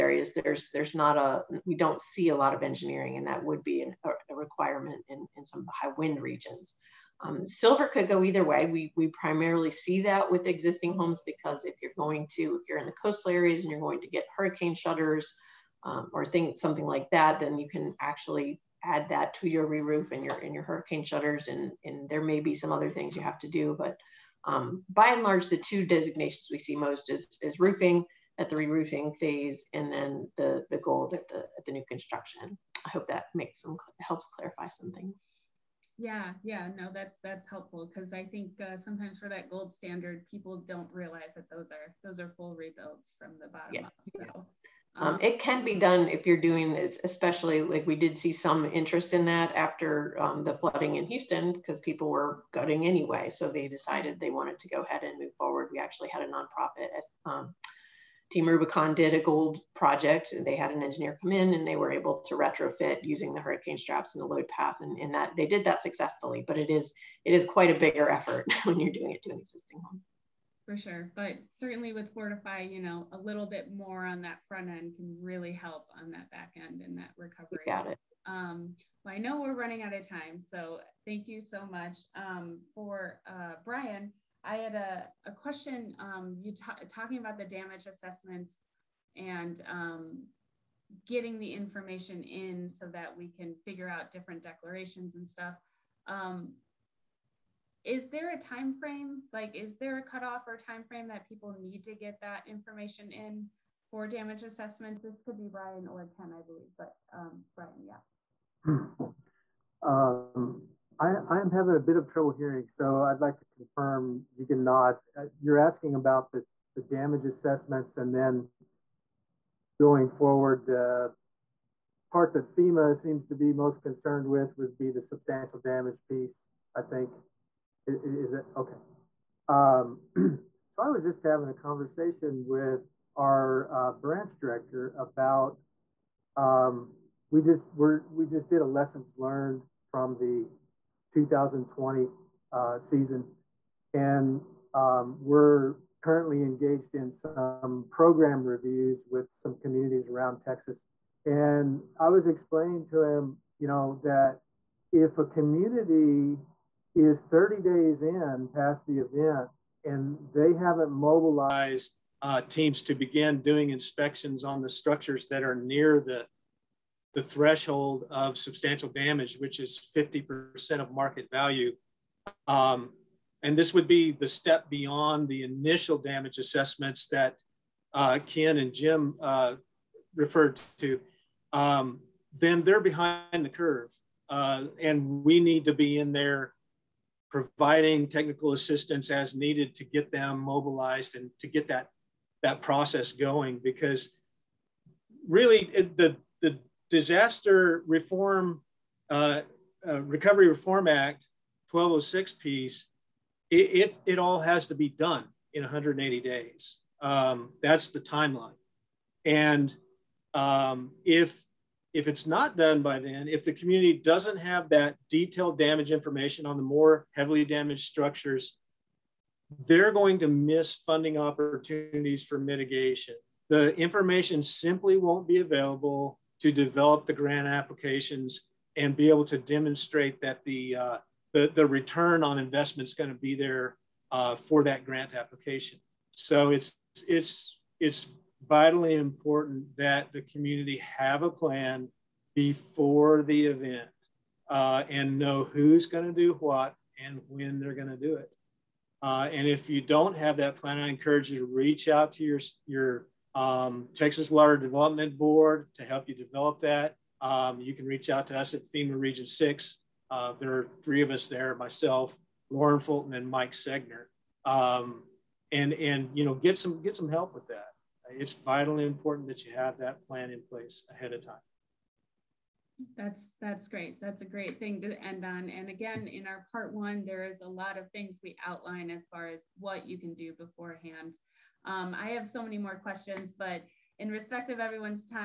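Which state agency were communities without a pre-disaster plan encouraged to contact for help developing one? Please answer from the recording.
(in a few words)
Texas Water Development Board.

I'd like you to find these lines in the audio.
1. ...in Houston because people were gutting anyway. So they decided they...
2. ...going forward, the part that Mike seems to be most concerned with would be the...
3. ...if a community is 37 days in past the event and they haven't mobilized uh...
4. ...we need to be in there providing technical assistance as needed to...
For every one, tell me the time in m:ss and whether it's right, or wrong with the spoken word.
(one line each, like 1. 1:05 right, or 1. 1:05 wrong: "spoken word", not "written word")
1. 0:50 right
2. 1:59 wrong: "FEMA", not "Mike"
3. 2:34 wrong: "30", not "37"
4. 3:05 right.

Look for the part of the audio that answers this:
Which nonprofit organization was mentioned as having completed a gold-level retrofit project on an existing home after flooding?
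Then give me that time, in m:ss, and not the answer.
0:58.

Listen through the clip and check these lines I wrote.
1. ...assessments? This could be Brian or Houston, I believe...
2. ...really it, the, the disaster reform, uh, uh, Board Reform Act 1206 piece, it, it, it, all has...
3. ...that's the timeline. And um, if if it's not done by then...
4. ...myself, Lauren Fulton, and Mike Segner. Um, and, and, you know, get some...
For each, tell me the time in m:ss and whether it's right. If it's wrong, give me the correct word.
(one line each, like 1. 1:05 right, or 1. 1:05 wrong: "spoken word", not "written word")
1. 1:44 wrong: "Ken", not "Houston"
2. 3:15 wrong: "Recovery", not "Board"
3. 3:27 right
4. 4:21 right.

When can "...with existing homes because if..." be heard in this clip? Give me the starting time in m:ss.
0:10.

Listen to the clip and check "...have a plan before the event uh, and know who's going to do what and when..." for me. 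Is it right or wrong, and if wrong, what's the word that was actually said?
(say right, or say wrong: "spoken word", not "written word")
right.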